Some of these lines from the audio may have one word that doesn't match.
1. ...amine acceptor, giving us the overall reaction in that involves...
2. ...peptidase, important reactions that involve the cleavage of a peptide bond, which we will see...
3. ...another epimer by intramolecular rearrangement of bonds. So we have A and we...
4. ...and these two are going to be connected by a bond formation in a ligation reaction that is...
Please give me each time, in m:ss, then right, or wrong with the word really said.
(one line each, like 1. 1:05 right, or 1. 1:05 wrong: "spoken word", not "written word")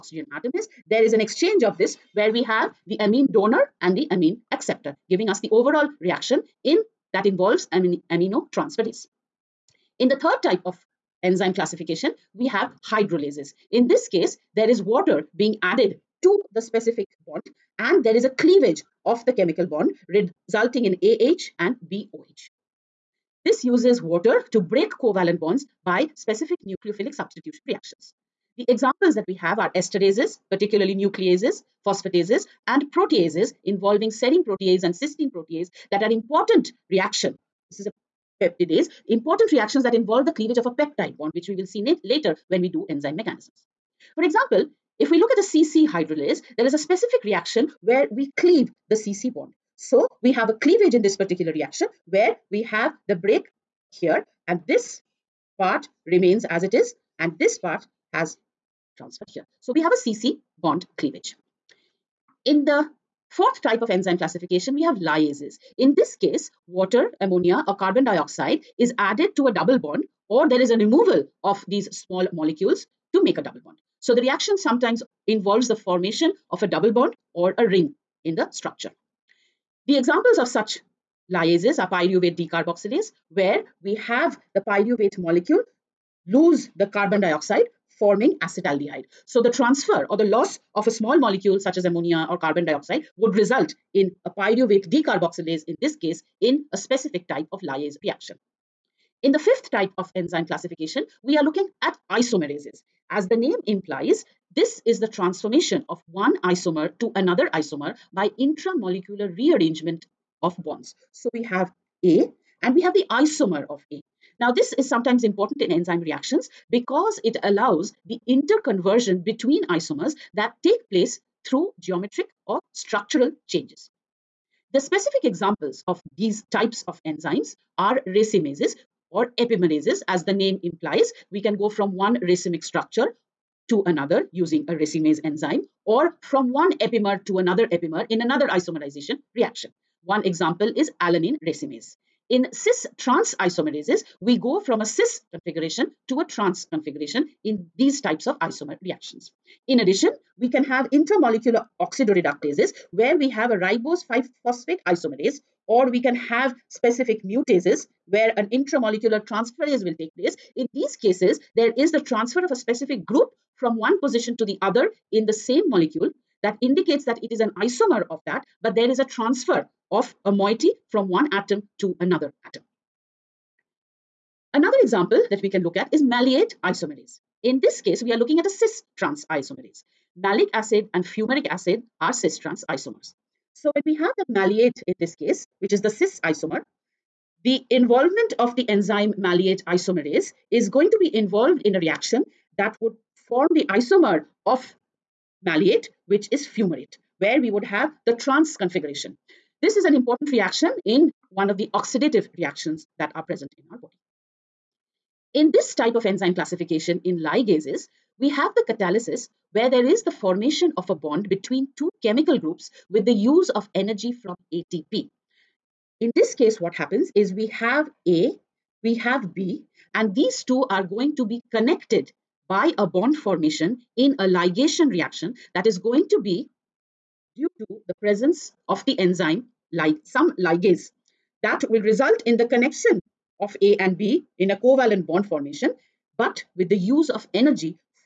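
1. 0:04 right
2. 0:38 right
3. 1:47 wrong: "isomer", not "epimer"
4. 3:39 right.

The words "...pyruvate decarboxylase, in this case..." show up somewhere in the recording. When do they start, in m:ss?
1:34.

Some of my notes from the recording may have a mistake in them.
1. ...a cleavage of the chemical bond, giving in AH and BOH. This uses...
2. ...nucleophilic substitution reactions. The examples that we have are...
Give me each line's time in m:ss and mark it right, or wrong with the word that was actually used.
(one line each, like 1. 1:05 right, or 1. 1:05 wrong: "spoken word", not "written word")
1. 0:18 wrong: "resulting", not "giving"
2. 0:26 right.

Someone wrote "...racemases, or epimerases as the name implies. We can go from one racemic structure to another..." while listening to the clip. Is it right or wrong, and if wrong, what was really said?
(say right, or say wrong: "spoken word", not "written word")
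right.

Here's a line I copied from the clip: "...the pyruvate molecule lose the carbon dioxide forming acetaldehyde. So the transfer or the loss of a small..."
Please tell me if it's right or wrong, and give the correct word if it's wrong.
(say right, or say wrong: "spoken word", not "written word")
right.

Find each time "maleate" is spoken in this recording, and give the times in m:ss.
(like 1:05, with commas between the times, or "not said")
2:56, 3:04, 3:09, 3:15.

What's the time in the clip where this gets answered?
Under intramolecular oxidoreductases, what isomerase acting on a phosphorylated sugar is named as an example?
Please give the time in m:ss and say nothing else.
2:33.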